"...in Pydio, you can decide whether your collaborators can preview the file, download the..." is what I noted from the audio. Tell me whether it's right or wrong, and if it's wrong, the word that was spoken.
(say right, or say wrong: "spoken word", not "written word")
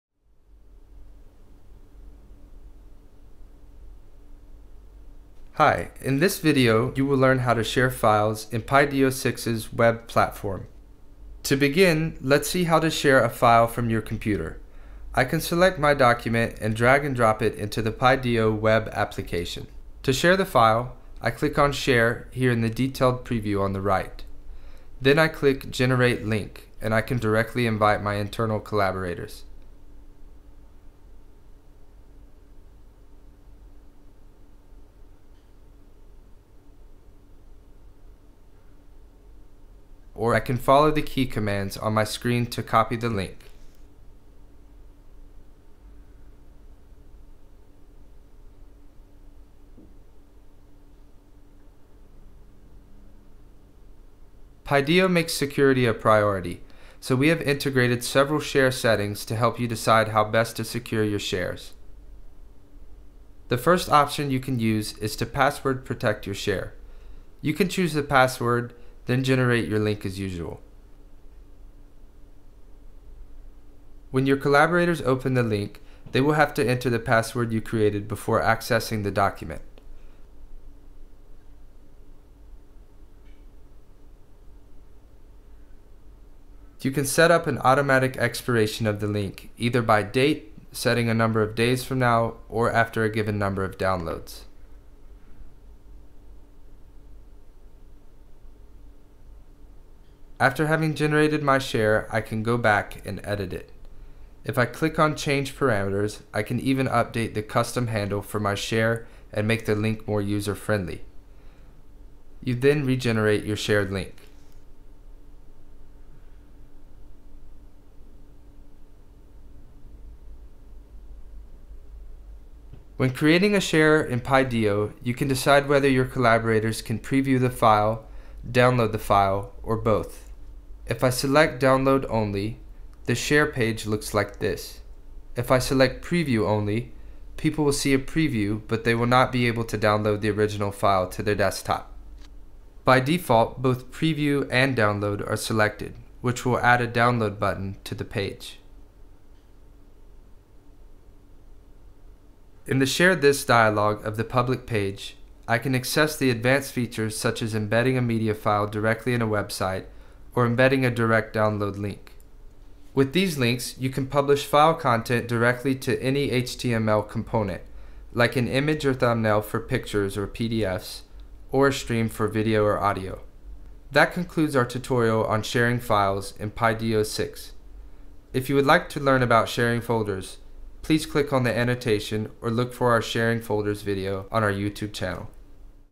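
right.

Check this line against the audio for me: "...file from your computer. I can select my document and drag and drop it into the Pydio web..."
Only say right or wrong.
right.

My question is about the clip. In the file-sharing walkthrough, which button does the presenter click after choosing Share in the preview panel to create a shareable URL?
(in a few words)
Generate Link.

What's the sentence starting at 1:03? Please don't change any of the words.
The first option you can use is to password protect your share.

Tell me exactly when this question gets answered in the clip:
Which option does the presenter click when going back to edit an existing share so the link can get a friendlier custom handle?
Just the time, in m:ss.
1:45.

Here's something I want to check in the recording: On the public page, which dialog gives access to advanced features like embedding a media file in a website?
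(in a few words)
Share This.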